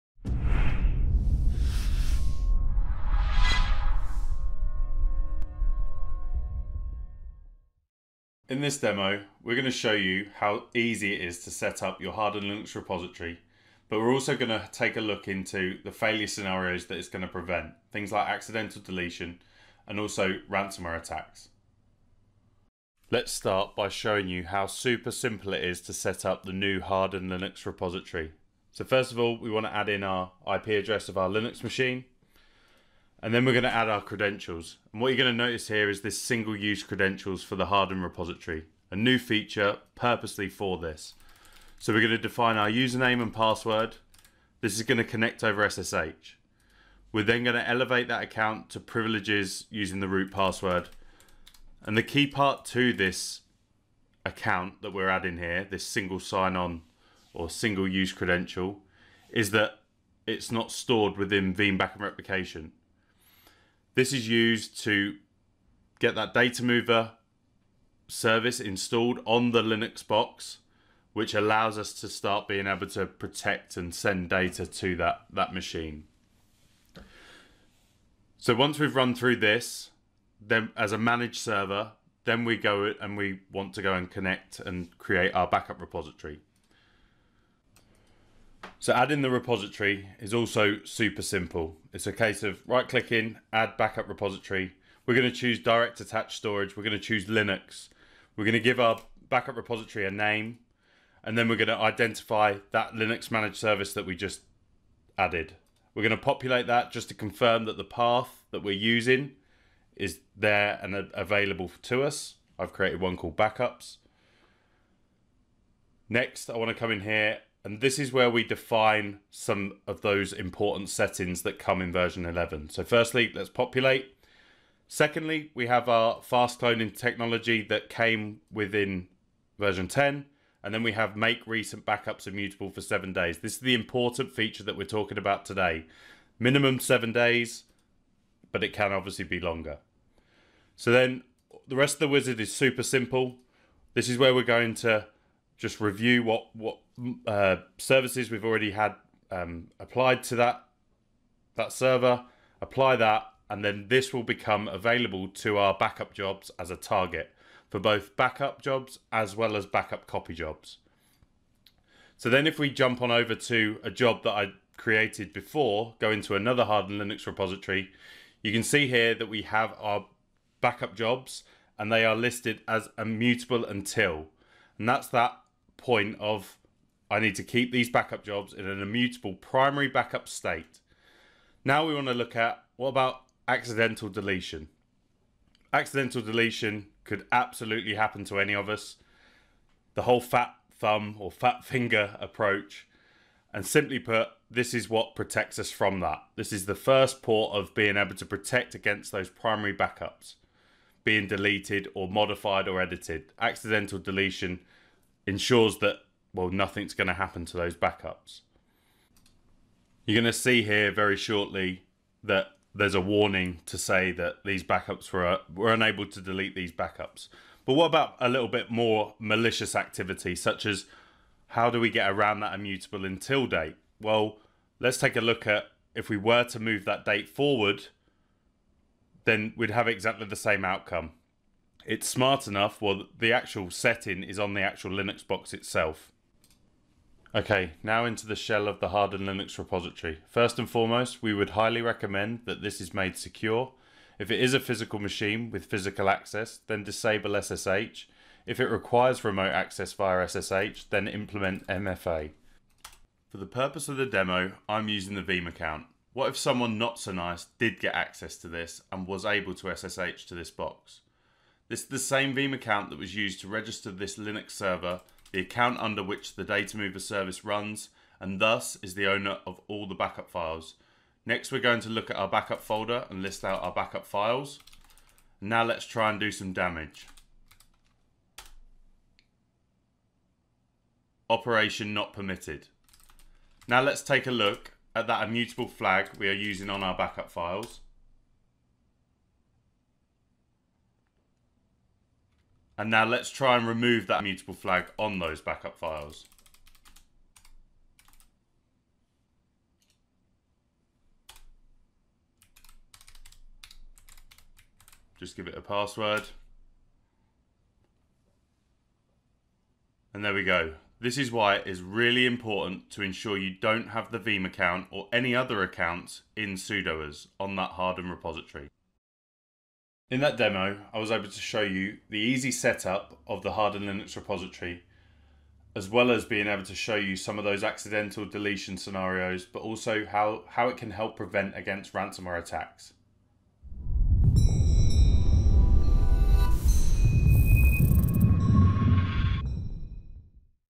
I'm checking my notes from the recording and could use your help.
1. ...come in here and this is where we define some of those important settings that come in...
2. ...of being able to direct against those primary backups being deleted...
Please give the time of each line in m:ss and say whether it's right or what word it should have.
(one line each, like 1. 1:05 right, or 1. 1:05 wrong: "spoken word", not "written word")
1. 1:56 right
2. 3:17 wrong: "protect", not "direct".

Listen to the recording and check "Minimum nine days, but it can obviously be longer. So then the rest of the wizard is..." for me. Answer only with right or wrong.
wrong.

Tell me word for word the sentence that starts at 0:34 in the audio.
And what you're going to notice here is this single use credentials for the hardened repository, a new feature purposely for this.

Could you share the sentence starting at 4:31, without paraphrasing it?
Next, we're going to look at our backup folder and list out our backup files.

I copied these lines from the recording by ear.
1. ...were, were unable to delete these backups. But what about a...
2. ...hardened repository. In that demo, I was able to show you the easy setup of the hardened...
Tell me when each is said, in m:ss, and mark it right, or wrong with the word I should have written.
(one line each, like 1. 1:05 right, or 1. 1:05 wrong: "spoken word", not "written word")
1. 3:35 right
2. 5:17 right.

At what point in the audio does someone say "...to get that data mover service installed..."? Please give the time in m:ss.
1:04.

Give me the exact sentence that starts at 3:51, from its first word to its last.
It's smart enough, well, the actual setting is on the actual Linux box itself.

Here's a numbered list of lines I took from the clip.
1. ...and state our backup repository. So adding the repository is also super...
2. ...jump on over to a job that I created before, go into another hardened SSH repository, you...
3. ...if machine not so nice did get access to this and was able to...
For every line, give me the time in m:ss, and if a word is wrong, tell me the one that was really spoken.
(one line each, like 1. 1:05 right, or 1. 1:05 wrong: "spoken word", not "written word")
1. 1:24 wrong: "create", not "state"
2. 2:42 wrong: "Linux", not "SSH"
3. 4:16 wrong: "someone", not "machine".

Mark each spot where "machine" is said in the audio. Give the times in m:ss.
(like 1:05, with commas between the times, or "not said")
0:31, 1:15, 4:04.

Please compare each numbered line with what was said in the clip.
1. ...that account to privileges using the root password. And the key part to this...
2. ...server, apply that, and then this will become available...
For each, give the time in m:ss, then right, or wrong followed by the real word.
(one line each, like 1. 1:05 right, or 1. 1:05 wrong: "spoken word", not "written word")
1. 0:48 right
2. 2:31 right.